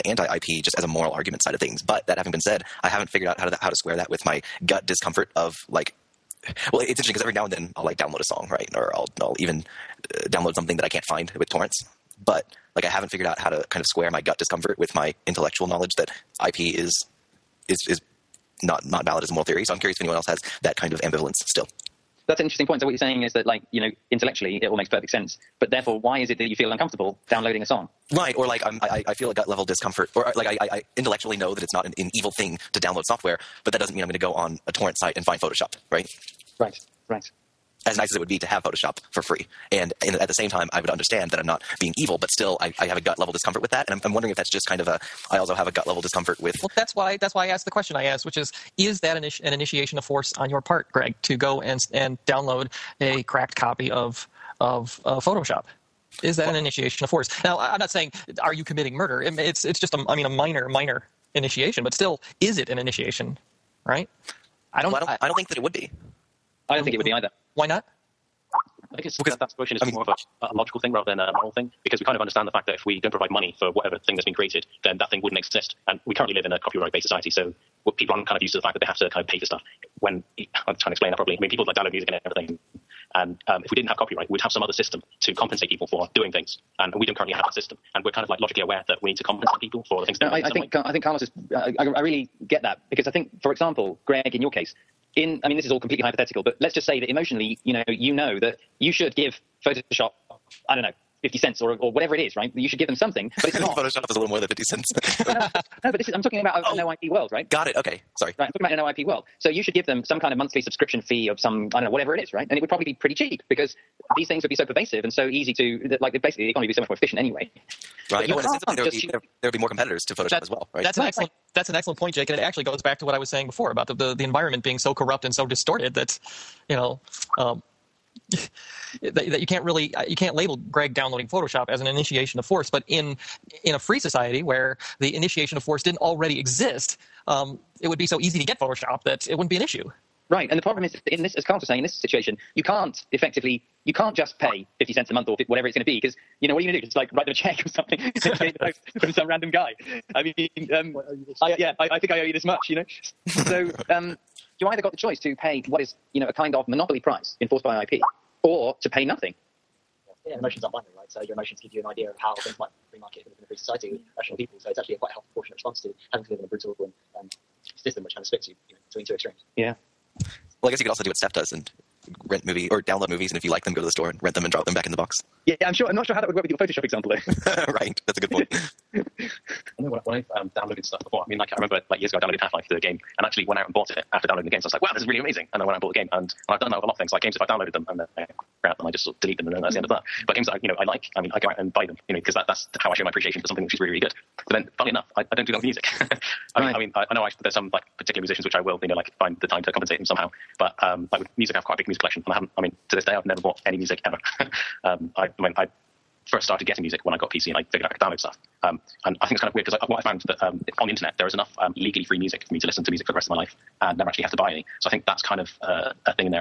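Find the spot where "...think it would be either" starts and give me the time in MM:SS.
01:06.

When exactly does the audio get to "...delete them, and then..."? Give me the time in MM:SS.
03:09.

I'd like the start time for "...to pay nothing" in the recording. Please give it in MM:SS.
02:38.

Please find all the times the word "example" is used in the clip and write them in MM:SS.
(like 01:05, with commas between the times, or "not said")
01:33, 02:56.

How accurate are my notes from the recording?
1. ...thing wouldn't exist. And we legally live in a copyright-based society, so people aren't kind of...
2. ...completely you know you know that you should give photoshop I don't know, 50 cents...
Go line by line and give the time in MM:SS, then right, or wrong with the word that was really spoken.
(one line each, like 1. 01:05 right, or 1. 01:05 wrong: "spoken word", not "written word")
1. 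01:15 wrong: "currently", not "legally"
2. 01:37 wrong: "emotionally", not "completely".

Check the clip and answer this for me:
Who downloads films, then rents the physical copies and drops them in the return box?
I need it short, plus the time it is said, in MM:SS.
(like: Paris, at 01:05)
Steph, at 02:51.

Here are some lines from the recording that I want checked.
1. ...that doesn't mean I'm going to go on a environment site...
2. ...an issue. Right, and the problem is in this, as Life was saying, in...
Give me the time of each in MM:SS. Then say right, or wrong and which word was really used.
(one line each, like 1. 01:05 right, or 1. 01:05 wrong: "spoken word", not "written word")
1. 00:33 wrong: "torrent", not "environment"
2. 02:19 wrong: "Carlos", not "Life".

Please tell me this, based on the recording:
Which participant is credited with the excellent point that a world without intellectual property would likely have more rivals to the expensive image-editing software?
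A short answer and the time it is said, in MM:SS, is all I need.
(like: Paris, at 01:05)
Jake, at 02:02.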